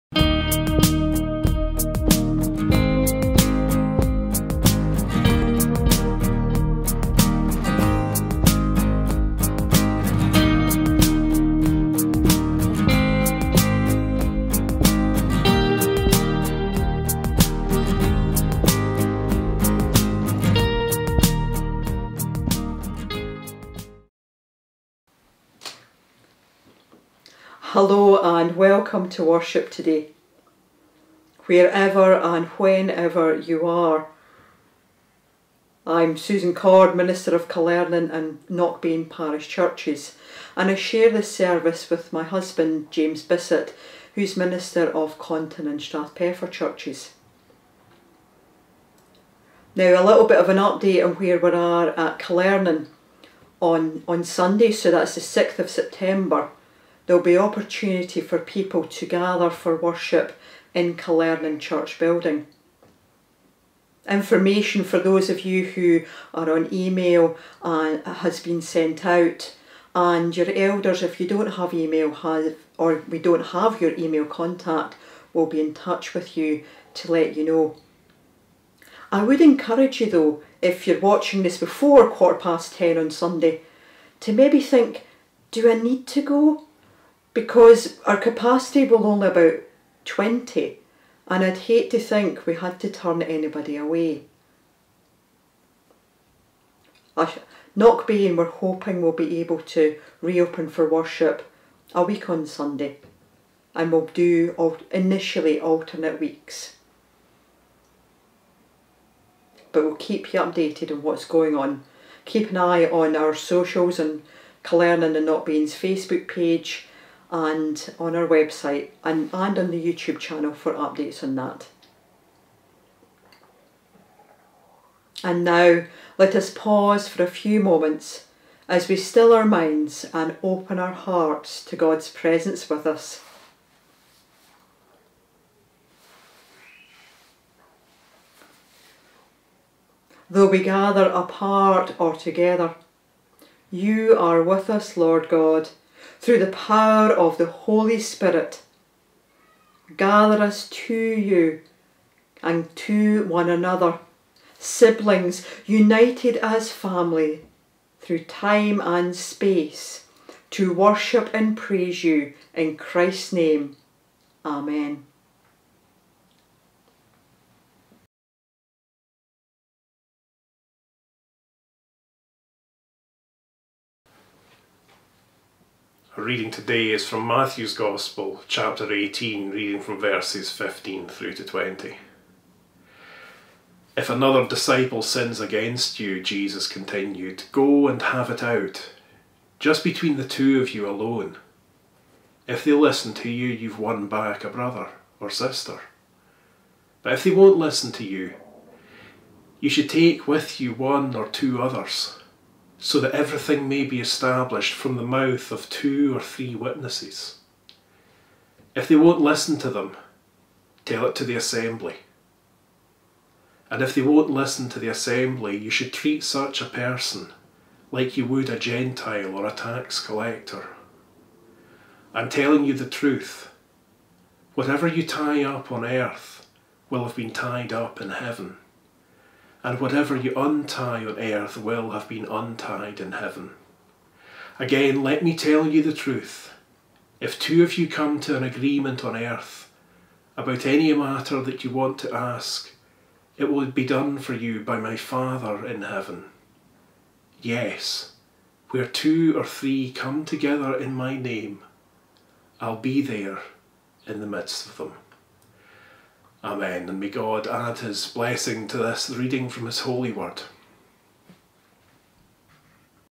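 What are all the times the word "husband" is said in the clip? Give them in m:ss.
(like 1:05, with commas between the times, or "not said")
0:42.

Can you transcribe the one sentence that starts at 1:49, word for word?
But we'll keep you updated on what's going on.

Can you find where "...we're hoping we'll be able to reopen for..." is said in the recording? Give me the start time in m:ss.
1:38.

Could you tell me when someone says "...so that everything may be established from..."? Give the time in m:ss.
3:22.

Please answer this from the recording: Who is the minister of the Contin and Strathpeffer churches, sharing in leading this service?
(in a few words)
James Bissett.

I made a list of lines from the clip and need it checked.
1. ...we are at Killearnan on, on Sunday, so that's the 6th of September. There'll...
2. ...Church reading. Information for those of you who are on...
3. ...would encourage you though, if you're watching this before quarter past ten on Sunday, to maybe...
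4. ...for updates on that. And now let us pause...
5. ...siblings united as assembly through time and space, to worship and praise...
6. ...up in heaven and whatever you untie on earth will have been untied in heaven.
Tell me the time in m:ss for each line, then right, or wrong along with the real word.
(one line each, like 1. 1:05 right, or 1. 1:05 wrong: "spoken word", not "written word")
1. 0:51 right
2. 1:01 wrong: "building", not "reading"
3. 1:19 right
4. 2:00 right
5. 2:34 wrong: "family", not "assembly"
6. 3:47 right.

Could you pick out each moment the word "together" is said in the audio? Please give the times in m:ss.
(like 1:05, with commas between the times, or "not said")
2:22, 4:10.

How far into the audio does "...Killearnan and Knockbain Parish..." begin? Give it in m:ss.
0:37.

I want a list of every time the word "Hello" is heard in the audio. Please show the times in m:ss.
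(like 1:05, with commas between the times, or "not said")
0:27.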